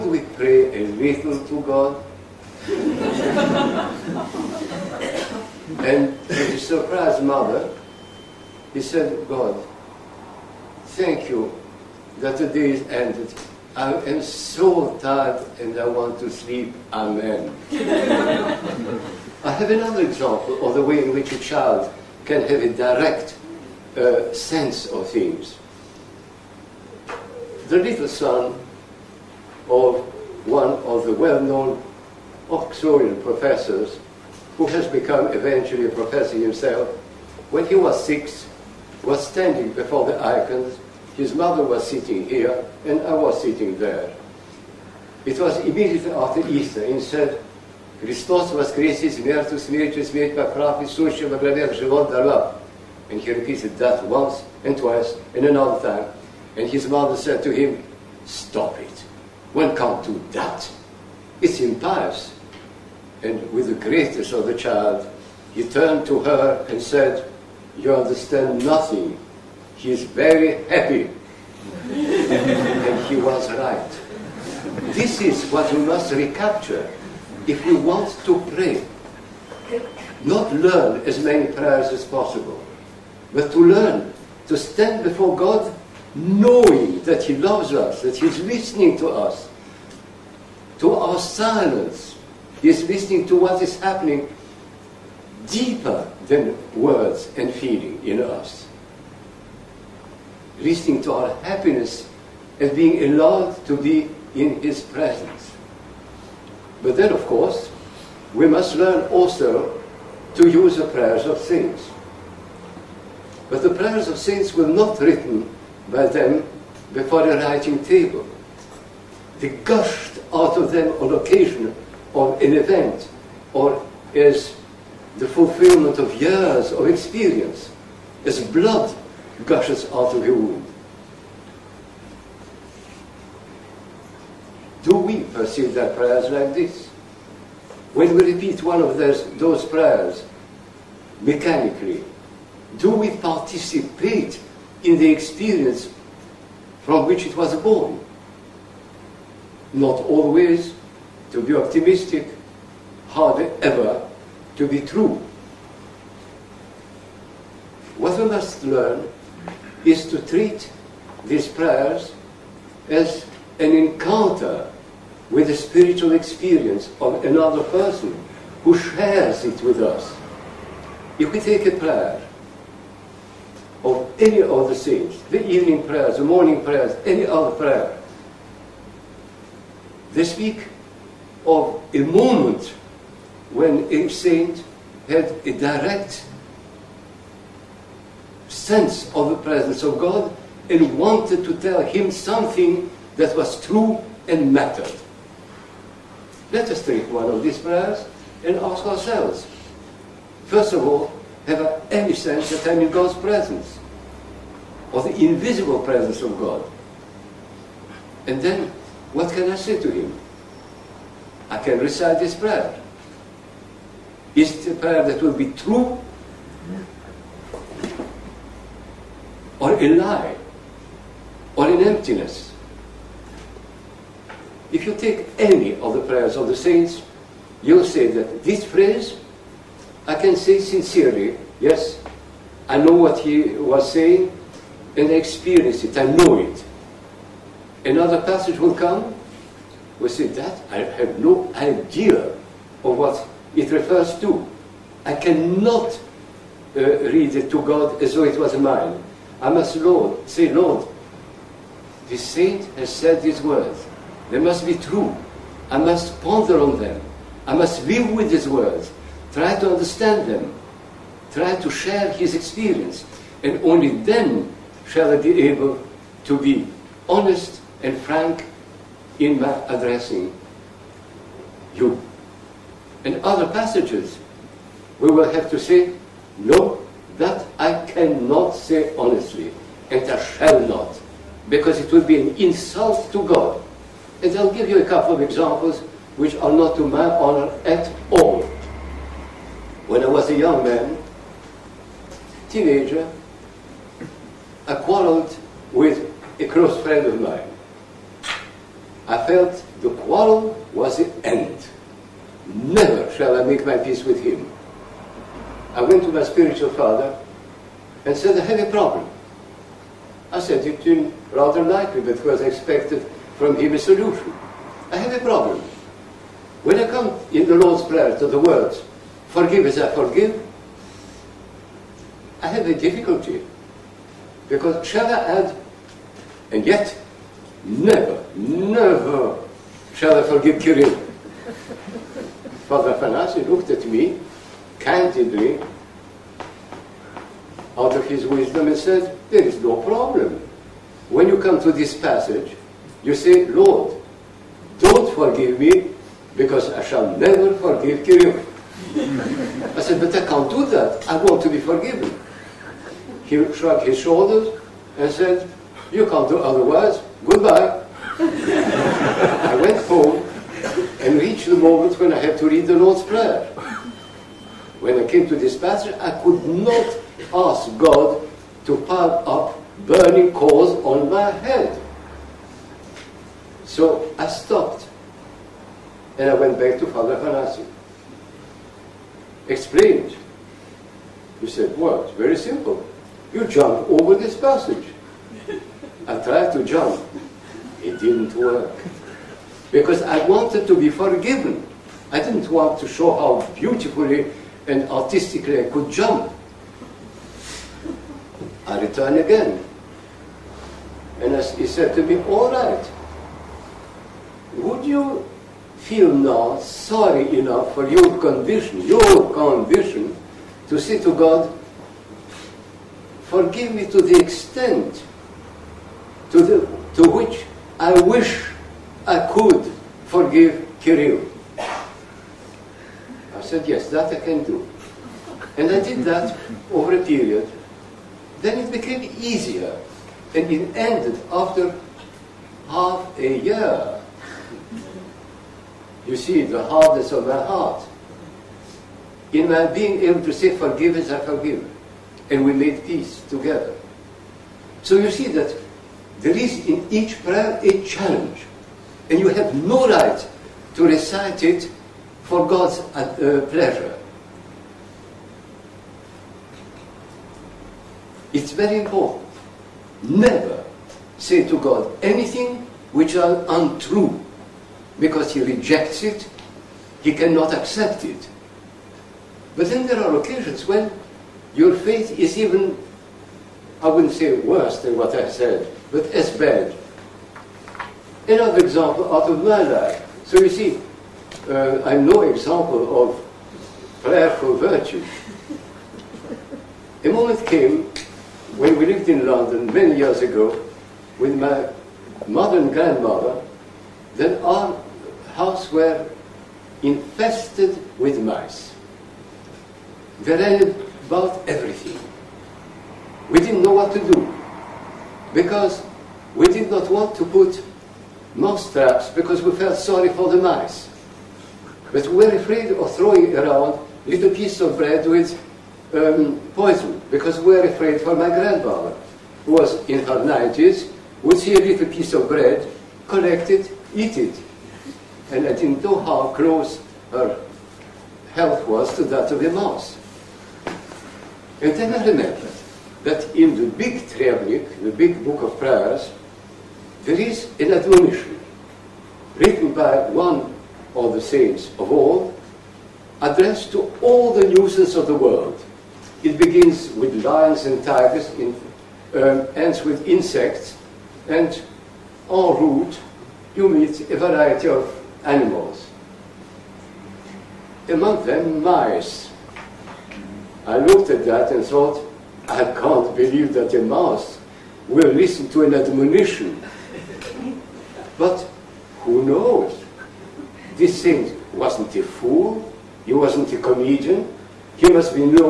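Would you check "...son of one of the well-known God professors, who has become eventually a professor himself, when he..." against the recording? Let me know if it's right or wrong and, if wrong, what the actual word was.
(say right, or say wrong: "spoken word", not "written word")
wrong: "Oxfordian", not "God".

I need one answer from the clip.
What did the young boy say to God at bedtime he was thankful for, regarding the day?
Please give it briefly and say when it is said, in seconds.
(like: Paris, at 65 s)
that the day is ended, at 12 s.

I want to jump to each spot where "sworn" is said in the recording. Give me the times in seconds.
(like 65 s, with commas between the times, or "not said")
not said.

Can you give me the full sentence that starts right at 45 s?
It was immediately after Easter, and said, Христос воскресе смерть, смертью смерть поправ, и сущим обравят живот дарла.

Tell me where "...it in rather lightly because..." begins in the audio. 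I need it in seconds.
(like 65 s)
310 s.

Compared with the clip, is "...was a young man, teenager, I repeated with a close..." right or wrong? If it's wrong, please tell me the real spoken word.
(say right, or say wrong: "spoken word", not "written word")
wrong: "quarreled", not "repeated".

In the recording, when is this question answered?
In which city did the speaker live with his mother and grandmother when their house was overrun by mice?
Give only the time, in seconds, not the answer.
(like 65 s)
489 s.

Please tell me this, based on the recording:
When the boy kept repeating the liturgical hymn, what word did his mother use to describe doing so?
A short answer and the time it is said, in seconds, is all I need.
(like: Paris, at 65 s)
Impious, at 61 s.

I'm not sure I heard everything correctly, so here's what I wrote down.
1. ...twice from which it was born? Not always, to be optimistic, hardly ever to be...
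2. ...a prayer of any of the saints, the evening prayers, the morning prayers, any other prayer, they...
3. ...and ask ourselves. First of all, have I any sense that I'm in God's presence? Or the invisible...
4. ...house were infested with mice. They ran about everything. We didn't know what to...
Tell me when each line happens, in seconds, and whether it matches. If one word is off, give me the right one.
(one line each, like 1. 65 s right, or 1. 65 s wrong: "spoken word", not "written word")
1. 145 s wrong: "experience", not "twice"
2. 171 s right
3. 198 s right
4. 495 s right.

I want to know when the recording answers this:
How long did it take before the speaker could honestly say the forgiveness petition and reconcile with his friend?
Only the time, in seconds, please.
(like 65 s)
432 s.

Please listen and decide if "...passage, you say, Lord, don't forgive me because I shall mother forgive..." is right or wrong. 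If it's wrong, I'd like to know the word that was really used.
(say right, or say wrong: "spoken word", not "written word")
wrong: "never", not "mother".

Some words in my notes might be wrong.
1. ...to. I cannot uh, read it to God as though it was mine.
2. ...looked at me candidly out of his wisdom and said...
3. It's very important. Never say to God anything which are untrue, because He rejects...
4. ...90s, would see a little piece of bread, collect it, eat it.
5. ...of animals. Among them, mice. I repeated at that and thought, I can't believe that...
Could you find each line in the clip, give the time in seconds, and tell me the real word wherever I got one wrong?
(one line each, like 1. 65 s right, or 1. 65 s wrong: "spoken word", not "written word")
1. 244 s right
2. 333 s right
3. 458 s right
4. 520 s right
5. 554 s wrong: "looked", not "repeated".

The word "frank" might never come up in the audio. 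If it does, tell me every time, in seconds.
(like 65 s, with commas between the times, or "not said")
267 s.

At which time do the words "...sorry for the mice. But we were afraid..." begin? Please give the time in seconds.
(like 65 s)
509 s.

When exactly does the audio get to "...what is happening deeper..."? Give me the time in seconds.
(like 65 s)
93 s.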